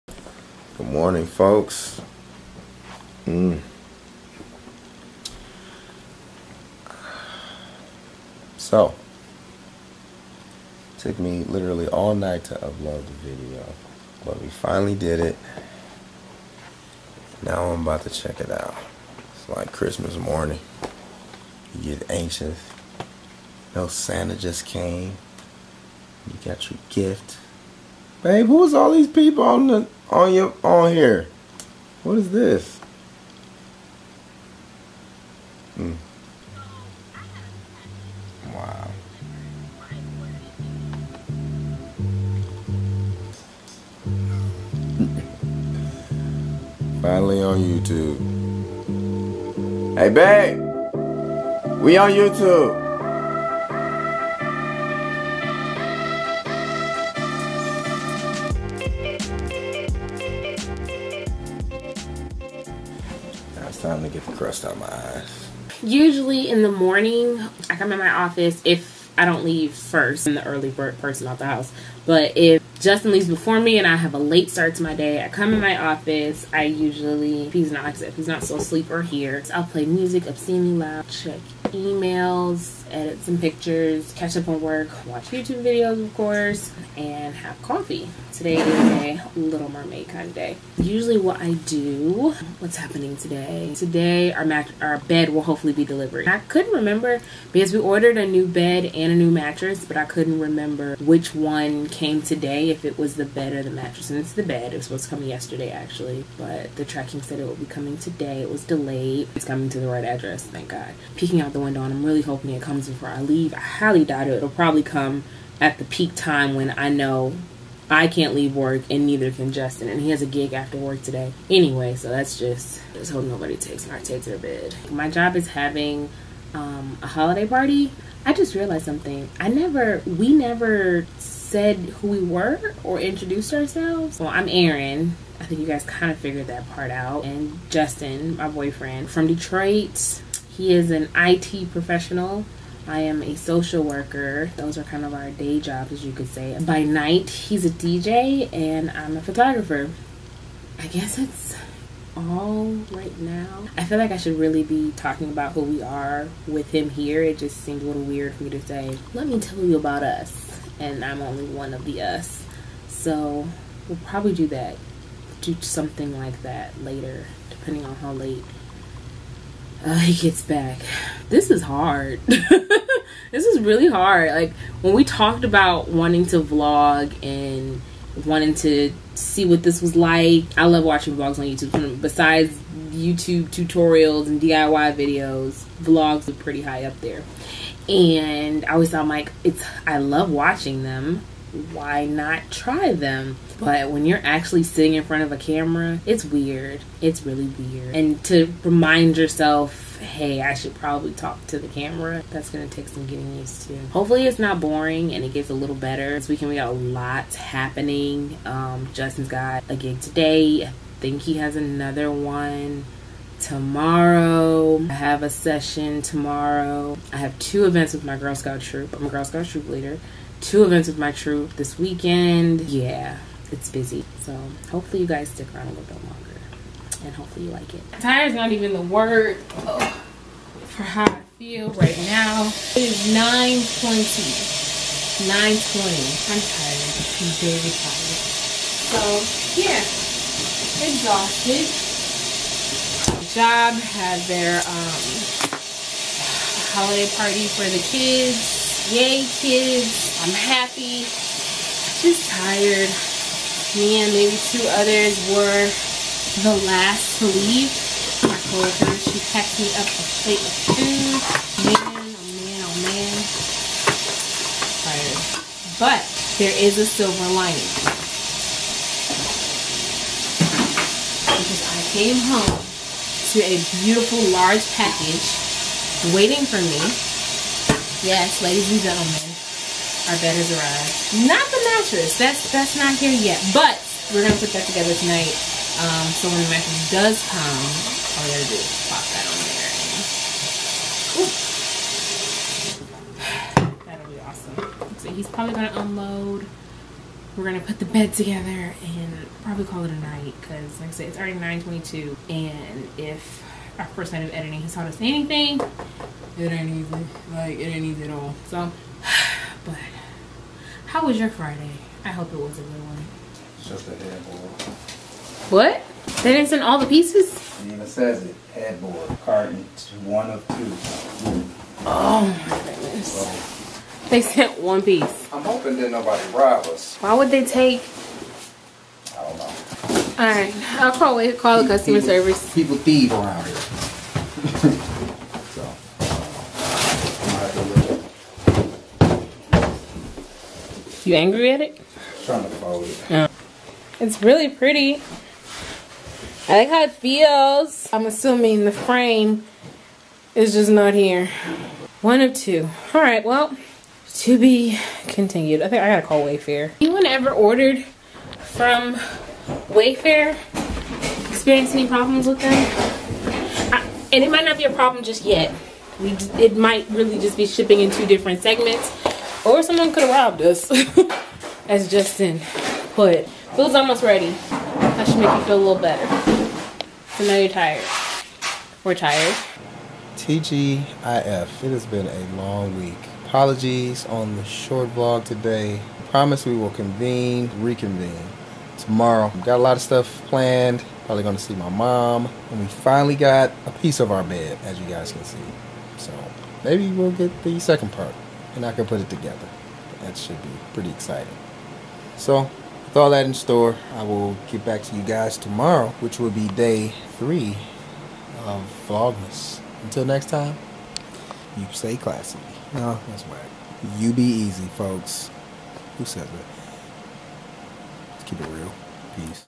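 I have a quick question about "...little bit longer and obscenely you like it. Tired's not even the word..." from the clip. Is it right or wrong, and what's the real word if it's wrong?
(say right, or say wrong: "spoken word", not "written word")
wrong: "hopefully", not "obscenely".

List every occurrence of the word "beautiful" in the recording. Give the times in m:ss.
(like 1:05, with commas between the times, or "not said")
4:33.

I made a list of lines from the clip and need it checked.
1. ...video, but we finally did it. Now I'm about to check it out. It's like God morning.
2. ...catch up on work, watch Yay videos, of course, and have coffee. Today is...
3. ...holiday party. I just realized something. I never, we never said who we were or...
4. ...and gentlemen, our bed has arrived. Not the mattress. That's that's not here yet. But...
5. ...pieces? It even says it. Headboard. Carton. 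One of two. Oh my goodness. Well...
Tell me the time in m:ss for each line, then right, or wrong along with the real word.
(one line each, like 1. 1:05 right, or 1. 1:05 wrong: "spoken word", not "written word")
1. 0:13 wrong: "Christmas", not "God"
2. 1:24 wrong: "YouTube", not "Yay"
3. 2:07 right
4. 4:38 right
5. 5:16 right.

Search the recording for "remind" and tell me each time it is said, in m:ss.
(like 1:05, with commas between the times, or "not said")
3:18.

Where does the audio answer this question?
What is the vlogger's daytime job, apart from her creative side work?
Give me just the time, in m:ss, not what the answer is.
2:23.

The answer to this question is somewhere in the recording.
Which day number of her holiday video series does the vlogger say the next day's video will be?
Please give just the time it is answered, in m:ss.
6:46.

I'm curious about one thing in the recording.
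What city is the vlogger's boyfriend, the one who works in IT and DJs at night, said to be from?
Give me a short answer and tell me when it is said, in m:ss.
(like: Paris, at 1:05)
Detroit, at 2:19.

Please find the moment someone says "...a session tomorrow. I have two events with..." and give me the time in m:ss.
3:35.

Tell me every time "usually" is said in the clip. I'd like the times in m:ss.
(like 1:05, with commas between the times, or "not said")
1:05, 1:16, 1:30.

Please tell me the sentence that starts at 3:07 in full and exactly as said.
And I always thought, like, it's I love watching them, why not try them?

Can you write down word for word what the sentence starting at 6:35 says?
So maybe we'll get the second part and I can put it together.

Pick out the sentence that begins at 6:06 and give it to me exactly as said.
We just, it might really just be shipping in two different segments, or someone could have robbed us.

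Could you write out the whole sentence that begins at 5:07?
Like, it ain't easy at all.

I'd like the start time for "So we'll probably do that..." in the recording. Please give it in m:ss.
2:42.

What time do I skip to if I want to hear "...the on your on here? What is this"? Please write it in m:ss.
0:29.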